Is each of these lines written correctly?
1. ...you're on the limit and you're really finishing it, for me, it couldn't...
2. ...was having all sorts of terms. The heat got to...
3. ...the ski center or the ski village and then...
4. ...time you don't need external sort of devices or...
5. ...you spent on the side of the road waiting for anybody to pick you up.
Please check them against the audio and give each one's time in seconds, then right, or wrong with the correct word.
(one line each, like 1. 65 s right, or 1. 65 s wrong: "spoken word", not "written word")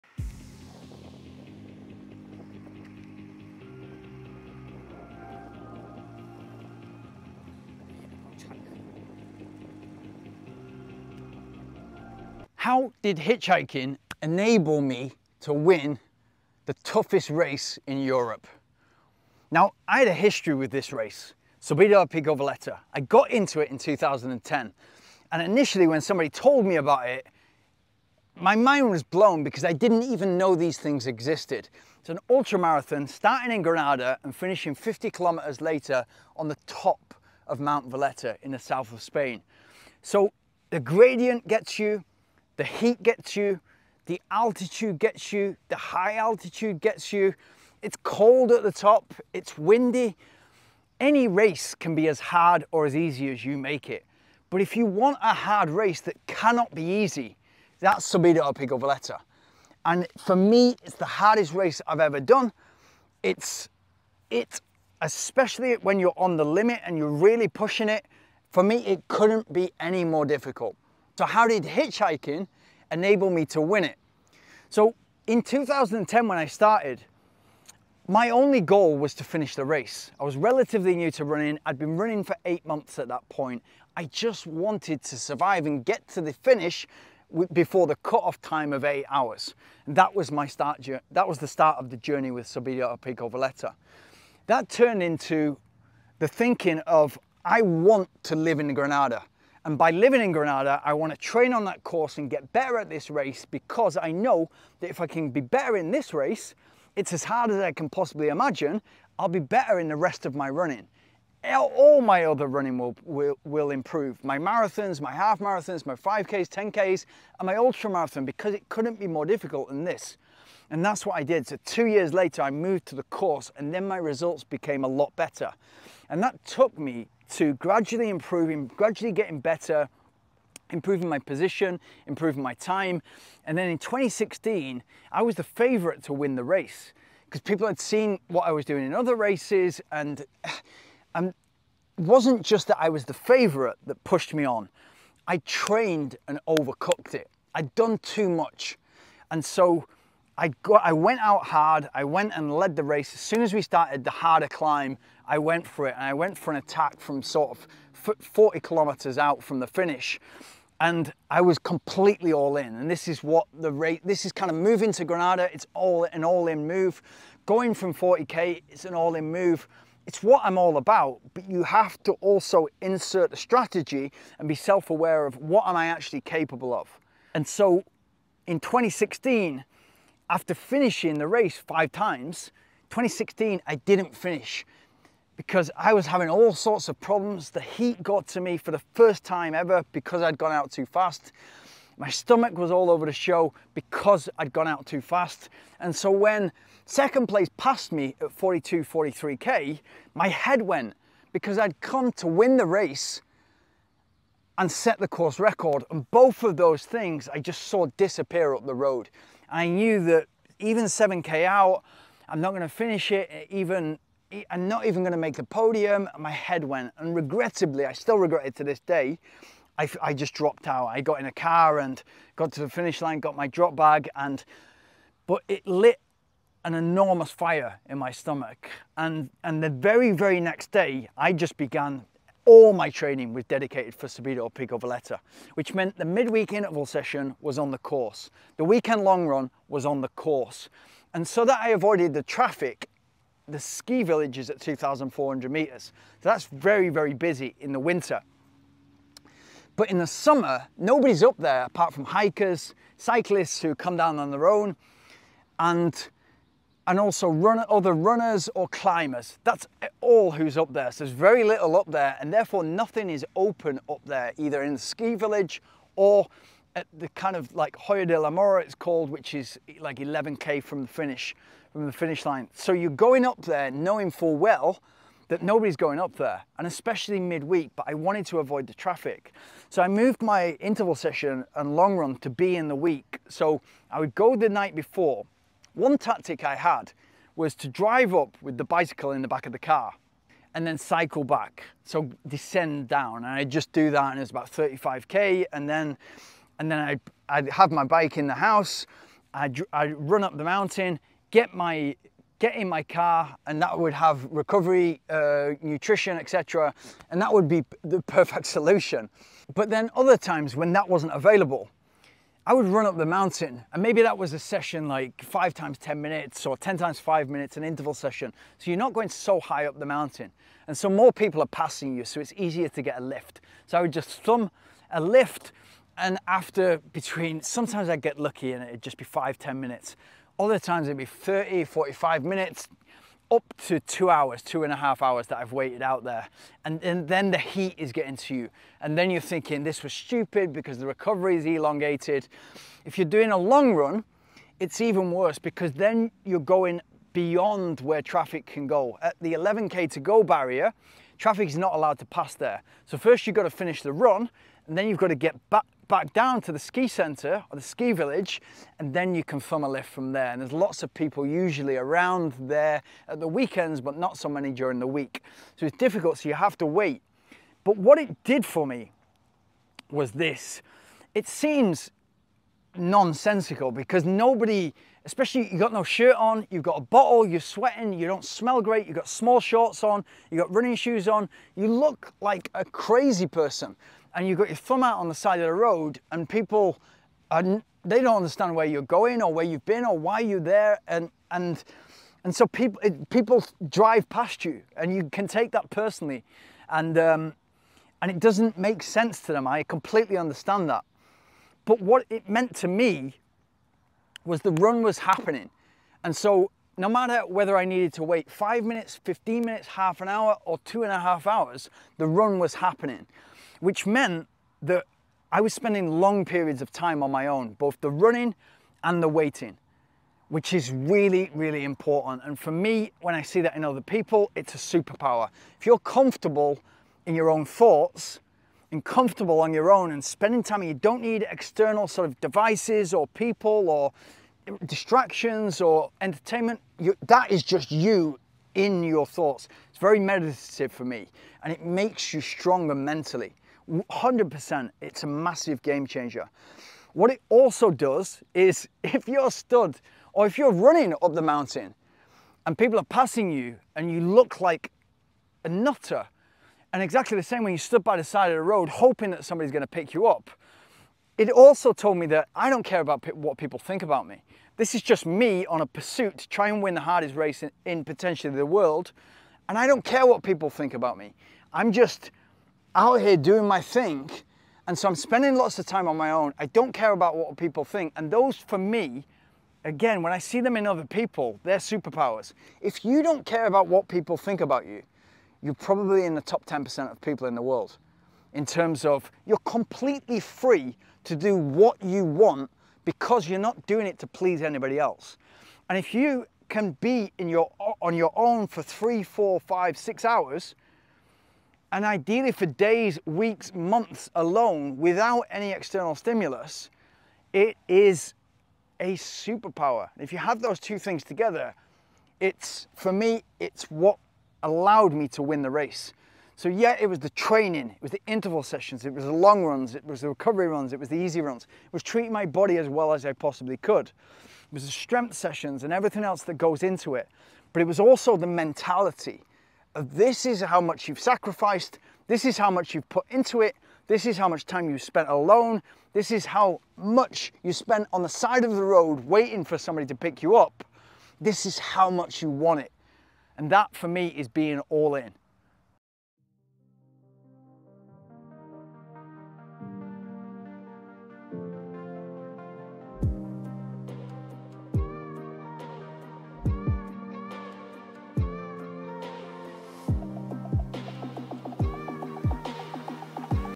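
1. 65 s wrong: "pushing", not "finishing"
2. 185 s wrong: "problems", not "terms"
3. 356 s right
4. 430 s right
5. 537 s wrong: "somebody", not "anybody".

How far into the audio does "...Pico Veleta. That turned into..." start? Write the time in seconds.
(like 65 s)
92 s.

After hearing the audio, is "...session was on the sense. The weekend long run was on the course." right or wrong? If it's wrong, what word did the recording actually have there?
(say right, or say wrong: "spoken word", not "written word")
wrong: "course", not "sense".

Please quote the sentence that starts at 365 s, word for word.
So it's difficult, so you have to wait.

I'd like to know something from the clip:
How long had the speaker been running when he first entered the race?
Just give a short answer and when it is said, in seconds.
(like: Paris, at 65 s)
8 months, at 82 s.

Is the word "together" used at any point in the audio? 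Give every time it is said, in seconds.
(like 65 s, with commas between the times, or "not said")
511 s.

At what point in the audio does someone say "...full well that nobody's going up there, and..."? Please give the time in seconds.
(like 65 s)
274 s.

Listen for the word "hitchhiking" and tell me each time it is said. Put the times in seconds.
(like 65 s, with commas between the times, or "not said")
13 s, 71 s.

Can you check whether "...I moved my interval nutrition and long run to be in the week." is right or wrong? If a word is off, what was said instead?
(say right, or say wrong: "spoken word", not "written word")
wrong: "session", not "nutrition".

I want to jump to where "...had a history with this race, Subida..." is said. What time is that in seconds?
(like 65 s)
19 s.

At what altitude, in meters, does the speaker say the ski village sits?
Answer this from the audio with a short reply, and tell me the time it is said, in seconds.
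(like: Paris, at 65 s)
2,400 meters, at 244 s.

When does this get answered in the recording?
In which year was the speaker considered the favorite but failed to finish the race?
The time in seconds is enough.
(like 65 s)
133 s.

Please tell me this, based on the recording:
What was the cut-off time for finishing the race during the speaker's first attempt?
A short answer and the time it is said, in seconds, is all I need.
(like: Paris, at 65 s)
8 hours, at 88 s.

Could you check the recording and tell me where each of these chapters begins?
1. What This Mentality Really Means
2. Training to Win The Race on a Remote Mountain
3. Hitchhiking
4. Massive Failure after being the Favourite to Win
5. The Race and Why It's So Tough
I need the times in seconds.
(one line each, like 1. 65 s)
1. 401 s
2. 226 s
3. 315 s
4. 136 s
5. 20 s.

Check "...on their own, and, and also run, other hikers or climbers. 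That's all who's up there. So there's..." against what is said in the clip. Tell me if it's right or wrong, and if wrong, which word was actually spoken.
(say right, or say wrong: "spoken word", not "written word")
wrong: "runners", not "hikers".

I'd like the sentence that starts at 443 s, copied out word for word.
100%, it's a massive game changer.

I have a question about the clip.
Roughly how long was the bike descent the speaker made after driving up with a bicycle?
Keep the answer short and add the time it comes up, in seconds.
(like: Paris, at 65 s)
35K, at 294 s.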